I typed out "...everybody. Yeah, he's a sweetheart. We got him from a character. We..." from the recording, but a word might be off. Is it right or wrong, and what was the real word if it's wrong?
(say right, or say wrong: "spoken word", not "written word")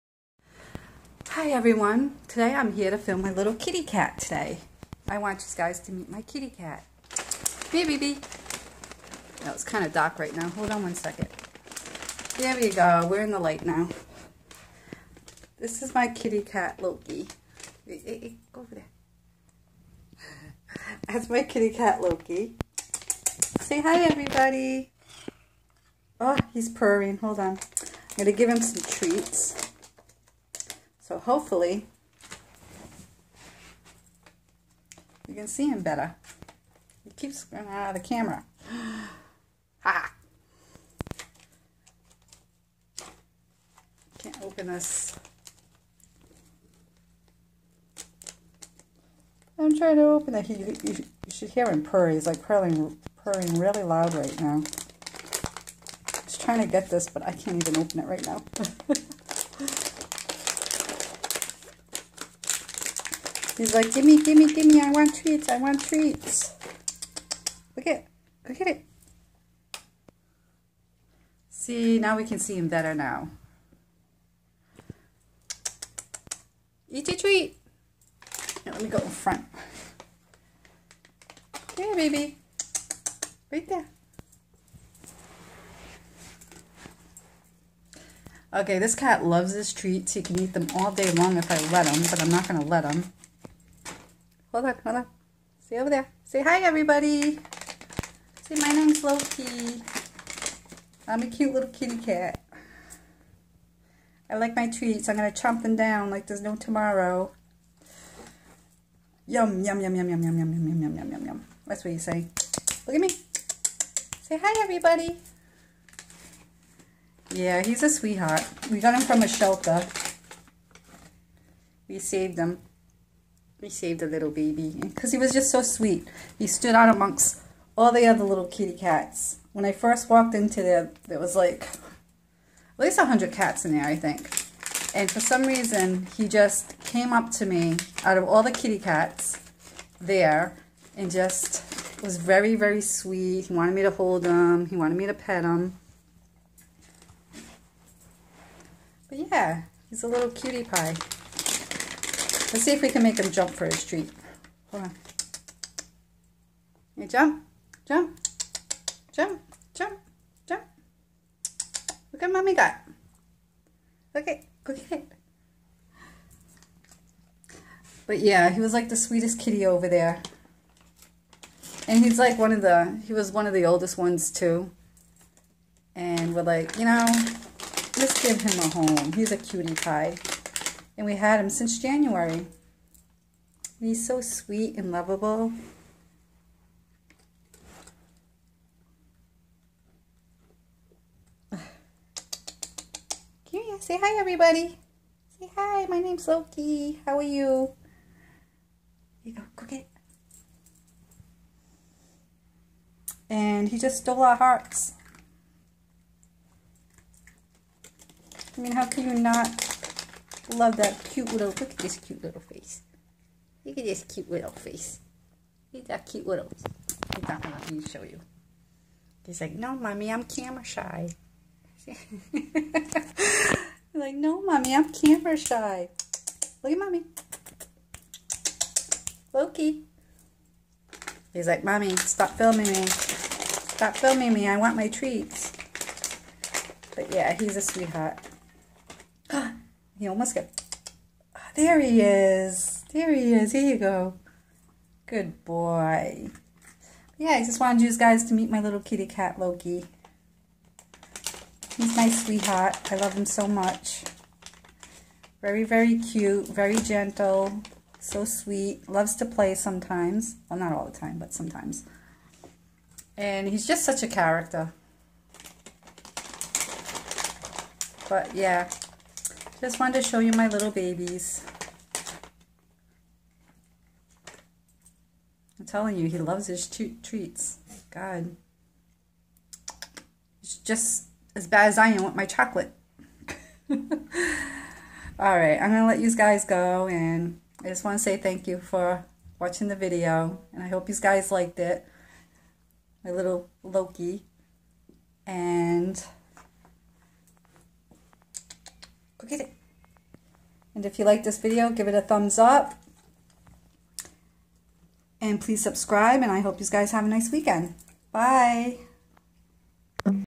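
wrong: "shelter", not "character".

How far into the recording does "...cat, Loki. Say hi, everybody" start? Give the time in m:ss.
0:21.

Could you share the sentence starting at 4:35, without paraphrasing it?
I'm telling you, he loves his treats.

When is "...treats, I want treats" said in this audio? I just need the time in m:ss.
1:05.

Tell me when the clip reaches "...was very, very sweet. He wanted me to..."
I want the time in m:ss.
2:22.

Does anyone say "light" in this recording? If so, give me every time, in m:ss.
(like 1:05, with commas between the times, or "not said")
0:13.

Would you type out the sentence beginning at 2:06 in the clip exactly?
He stood out amongst all the other little kitty cats.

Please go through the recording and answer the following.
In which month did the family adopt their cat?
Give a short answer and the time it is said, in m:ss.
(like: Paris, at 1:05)
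January, at 3:01.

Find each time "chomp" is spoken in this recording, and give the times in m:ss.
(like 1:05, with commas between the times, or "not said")
1:45.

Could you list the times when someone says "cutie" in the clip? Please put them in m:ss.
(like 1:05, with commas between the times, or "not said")
2:30, 2:59.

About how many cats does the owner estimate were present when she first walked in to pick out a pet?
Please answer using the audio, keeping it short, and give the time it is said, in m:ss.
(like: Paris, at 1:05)
100, at 2:12.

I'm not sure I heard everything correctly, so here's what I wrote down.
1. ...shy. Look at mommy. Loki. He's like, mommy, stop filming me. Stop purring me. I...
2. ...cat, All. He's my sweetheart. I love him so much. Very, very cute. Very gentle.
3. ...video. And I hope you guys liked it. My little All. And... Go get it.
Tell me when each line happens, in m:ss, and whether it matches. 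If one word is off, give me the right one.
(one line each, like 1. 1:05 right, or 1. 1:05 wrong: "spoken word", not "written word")
1. 3:45 wrong: "filming", not "purring"
2. 4:09 wrong: "Loki", not "All"
3. 4:49 wrong: "Loki", not "All".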